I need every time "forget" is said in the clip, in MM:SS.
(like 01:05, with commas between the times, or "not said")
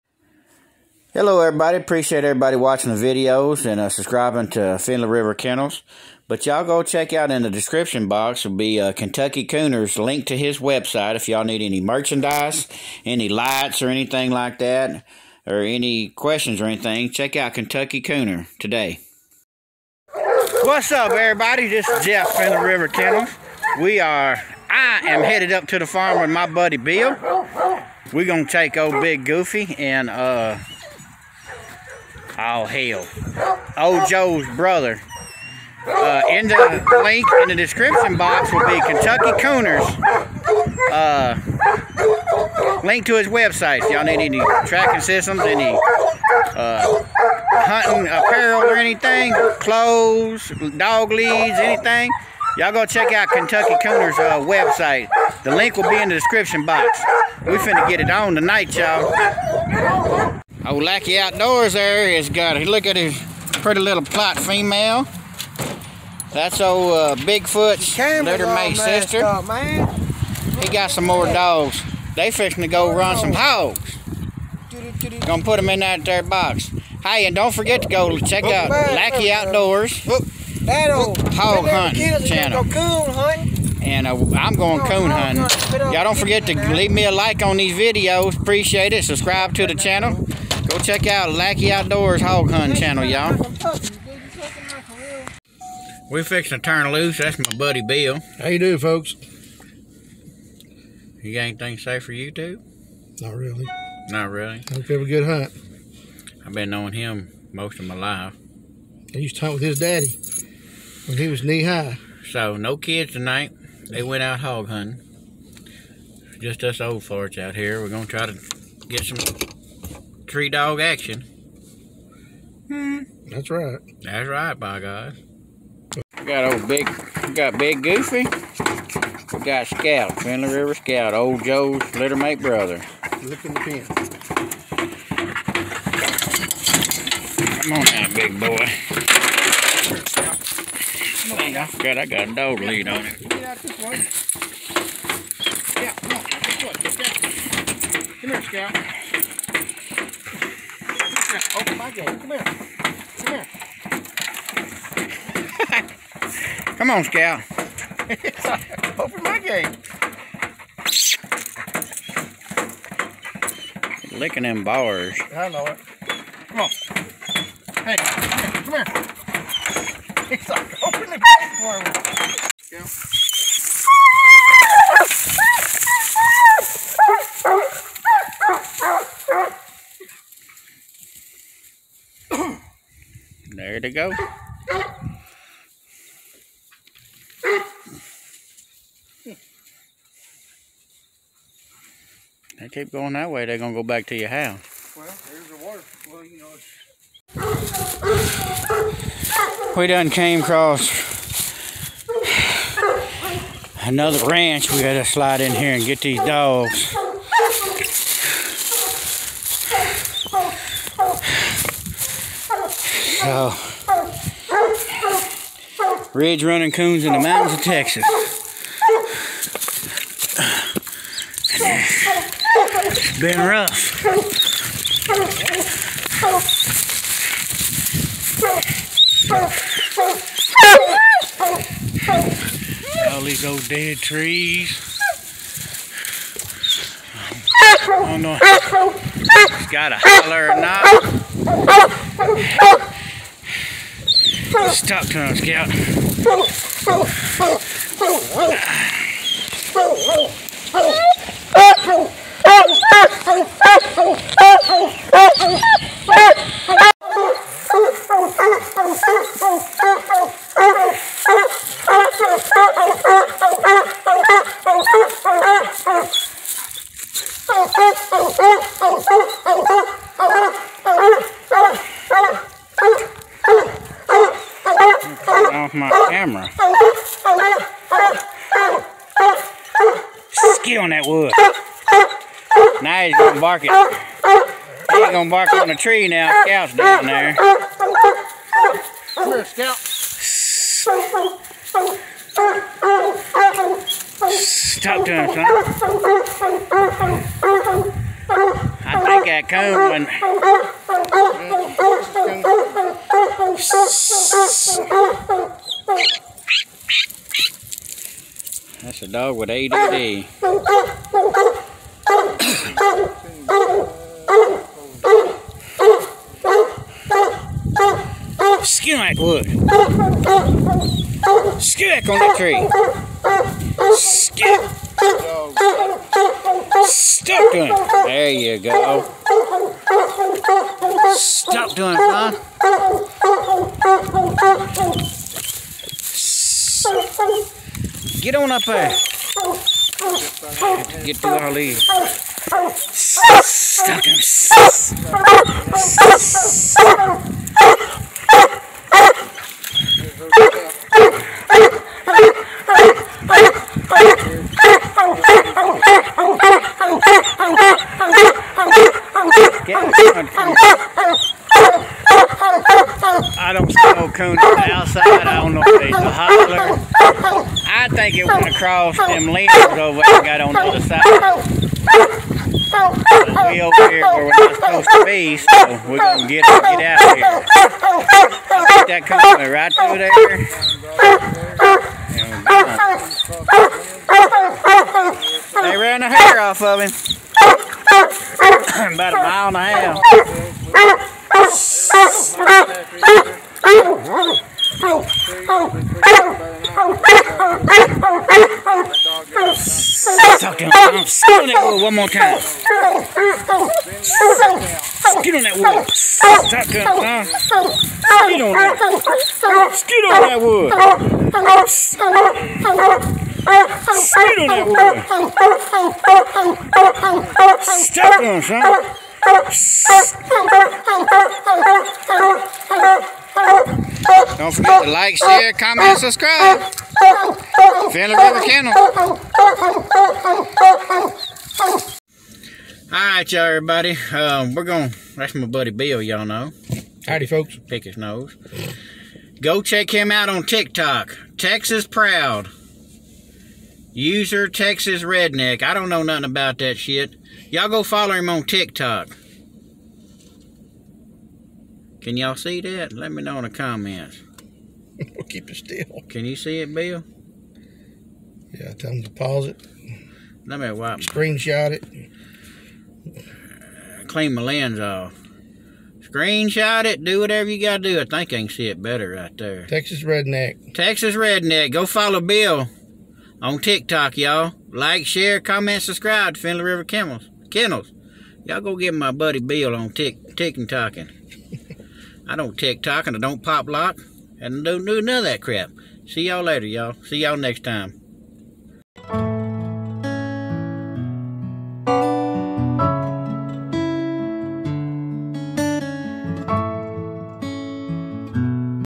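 01:17, 01:26, 07:04.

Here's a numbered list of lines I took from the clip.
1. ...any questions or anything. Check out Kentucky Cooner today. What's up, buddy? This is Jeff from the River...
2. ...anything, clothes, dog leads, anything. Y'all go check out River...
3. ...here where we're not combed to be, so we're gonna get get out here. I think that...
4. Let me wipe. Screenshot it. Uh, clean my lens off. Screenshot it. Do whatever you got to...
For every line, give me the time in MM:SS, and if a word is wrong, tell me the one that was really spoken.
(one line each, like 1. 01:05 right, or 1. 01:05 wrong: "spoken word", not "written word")
1. 00:15 wrong: "everybody", not "buddy"
2. 00:48 wrong: "Kentucky", not "River"
3. 06:13 wrong: "supposed", not "combed"
4. 07:40 right.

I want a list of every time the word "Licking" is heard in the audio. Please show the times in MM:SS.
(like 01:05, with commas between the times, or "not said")
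02:44.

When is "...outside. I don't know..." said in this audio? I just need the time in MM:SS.
06:04.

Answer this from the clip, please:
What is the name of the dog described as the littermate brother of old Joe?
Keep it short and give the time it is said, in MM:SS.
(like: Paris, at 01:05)
Finley River Scout, at 02:10.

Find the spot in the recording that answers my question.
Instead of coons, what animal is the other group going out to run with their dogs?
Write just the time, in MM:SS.
01:13.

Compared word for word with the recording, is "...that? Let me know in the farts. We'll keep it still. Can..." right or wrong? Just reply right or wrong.
wrong.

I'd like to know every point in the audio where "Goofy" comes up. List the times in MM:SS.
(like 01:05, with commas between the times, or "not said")
00:29, 02:07.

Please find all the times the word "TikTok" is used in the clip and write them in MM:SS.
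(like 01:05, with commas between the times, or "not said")
07:20, 07:28, 07:53, 08:02.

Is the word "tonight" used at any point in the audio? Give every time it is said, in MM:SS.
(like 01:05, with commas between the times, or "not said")
00:58, 01:53.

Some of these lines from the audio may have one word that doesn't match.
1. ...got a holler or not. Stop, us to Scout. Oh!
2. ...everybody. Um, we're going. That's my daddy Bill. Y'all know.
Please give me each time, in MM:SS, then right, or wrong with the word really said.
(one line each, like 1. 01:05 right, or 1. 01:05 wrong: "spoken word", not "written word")
1. 03:59 right
2. 07:13 wrong: "buddy", not "daddy".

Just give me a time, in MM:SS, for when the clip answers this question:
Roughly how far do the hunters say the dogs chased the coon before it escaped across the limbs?
06:27.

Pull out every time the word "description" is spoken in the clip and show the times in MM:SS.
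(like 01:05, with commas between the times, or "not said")
00:07, 00:37, 00:56.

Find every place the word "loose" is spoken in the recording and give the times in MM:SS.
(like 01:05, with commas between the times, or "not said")
01:36.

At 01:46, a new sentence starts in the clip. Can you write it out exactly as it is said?
I've been knowing him most of my life.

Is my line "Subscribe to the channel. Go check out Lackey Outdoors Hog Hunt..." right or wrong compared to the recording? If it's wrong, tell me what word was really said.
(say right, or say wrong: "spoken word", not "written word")
right.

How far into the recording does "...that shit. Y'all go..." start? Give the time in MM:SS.
07:26.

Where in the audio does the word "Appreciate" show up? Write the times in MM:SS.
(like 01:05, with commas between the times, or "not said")
00:01, 01:28.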